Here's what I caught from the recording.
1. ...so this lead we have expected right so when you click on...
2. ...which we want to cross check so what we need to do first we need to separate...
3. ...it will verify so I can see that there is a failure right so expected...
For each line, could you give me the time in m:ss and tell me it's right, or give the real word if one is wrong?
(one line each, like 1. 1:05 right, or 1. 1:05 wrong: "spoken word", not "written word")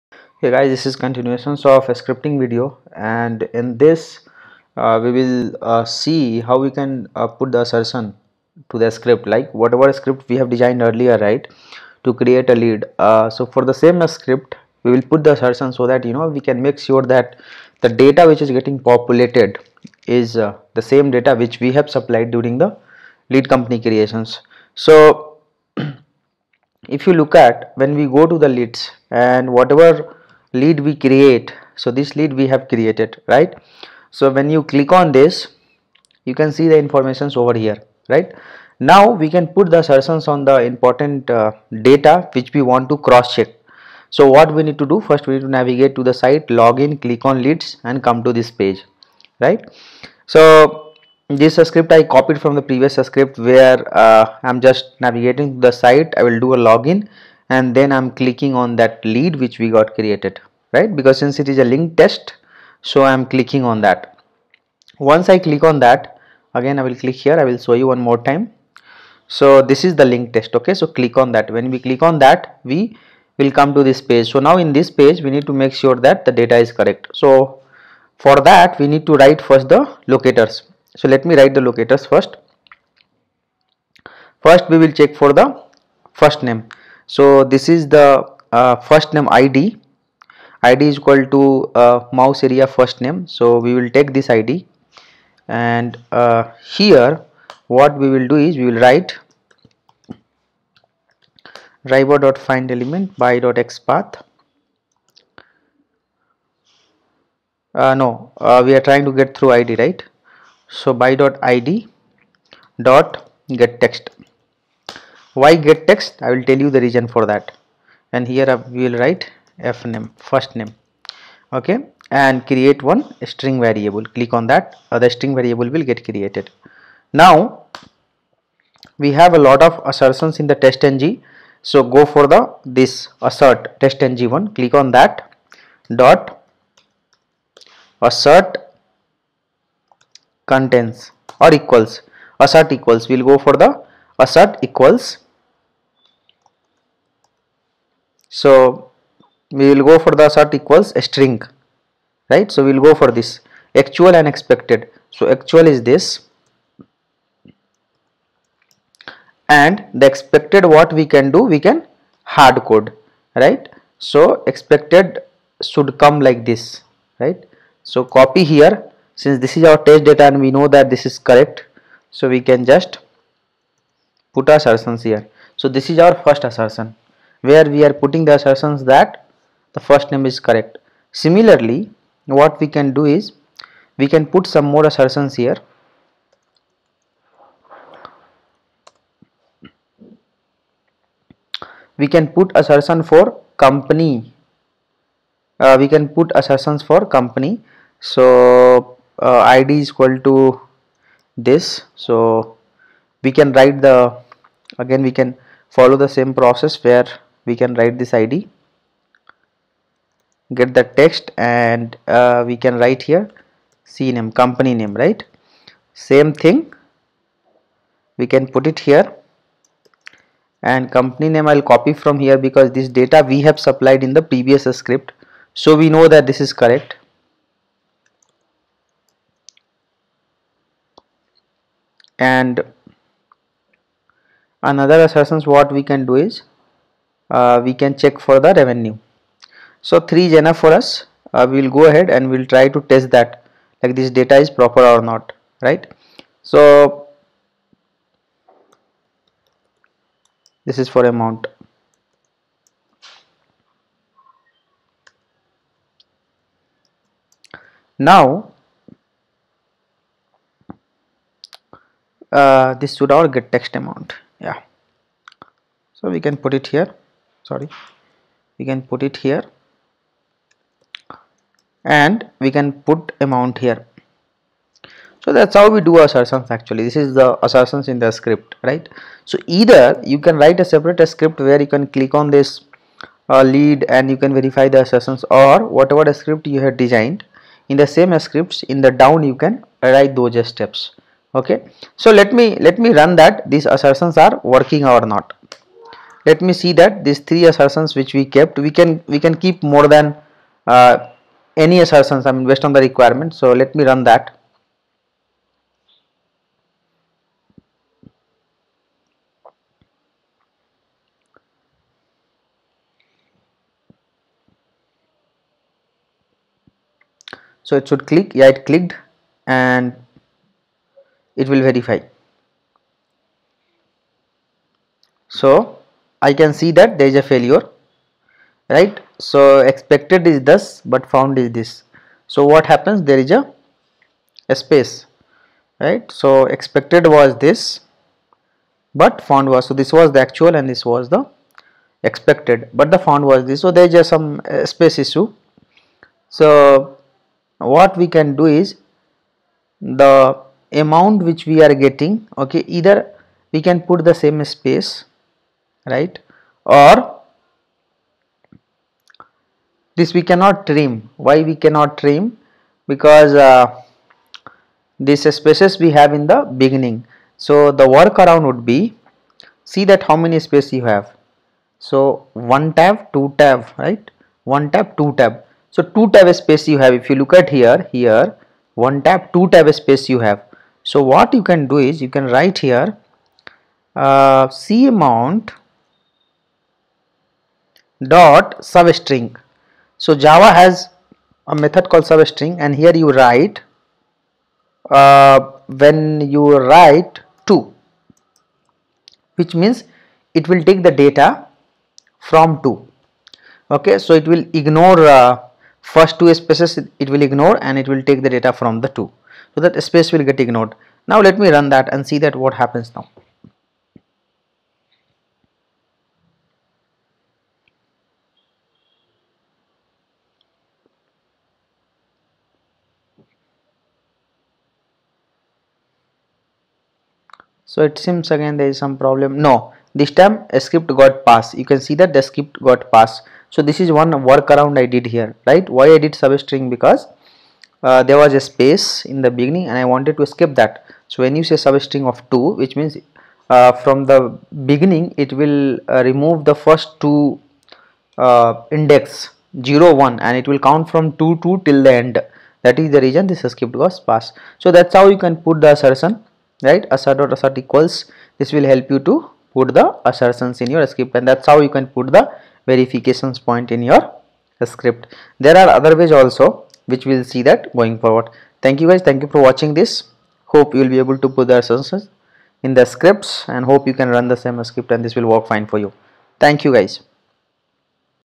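1. 0:31 wrong: "created", not "expected"
2. 0:42 wrong: "navigate", not "separate"
3. 5:21 right.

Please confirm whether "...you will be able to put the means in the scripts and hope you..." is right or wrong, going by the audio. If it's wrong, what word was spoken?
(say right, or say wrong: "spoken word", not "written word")
wrong: "assertions", not "means".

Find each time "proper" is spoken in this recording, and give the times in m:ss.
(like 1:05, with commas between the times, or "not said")
4:04.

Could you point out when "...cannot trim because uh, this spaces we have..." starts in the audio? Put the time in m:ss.
6:01.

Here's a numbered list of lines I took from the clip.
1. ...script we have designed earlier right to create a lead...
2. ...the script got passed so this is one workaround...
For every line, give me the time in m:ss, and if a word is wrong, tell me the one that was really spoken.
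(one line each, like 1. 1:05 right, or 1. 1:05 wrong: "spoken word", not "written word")
1. 0:09 right
2. 7:12 right.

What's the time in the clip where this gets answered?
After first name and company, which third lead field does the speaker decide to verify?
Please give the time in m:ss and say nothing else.
3:58.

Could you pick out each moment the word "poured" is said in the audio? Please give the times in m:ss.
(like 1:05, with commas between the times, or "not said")
not said.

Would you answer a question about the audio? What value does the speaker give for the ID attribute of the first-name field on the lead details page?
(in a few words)
mouse area first name.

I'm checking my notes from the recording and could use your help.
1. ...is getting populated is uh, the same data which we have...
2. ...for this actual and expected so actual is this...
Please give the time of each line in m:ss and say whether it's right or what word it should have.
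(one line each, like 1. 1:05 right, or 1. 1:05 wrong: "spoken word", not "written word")
1. 0:18 right
2. 2:32 right.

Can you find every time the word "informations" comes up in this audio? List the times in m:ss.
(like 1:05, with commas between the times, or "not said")
0:36.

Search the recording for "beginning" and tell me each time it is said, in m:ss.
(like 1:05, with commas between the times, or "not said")
6:06, 7:19, 7:24.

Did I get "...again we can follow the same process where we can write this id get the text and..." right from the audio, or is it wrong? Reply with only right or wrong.
right.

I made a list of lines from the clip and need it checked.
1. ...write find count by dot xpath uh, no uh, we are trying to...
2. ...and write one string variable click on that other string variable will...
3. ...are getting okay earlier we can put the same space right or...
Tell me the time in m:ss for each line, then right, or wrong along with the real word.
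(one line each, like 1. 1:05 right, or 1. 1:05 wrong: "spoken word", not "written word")
1. 1:38 wrong: "element", not "count"
2. 2:02 wrong: "create", not "write"
3. 5:51 wrong: "either", not "earlier".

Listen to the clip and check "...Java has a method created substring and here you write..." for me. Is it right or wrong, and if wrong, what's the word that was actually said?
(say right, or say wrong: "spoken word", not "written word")
wrong: "called", not "created".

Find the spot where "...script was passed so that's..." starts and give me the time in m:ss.
7:33.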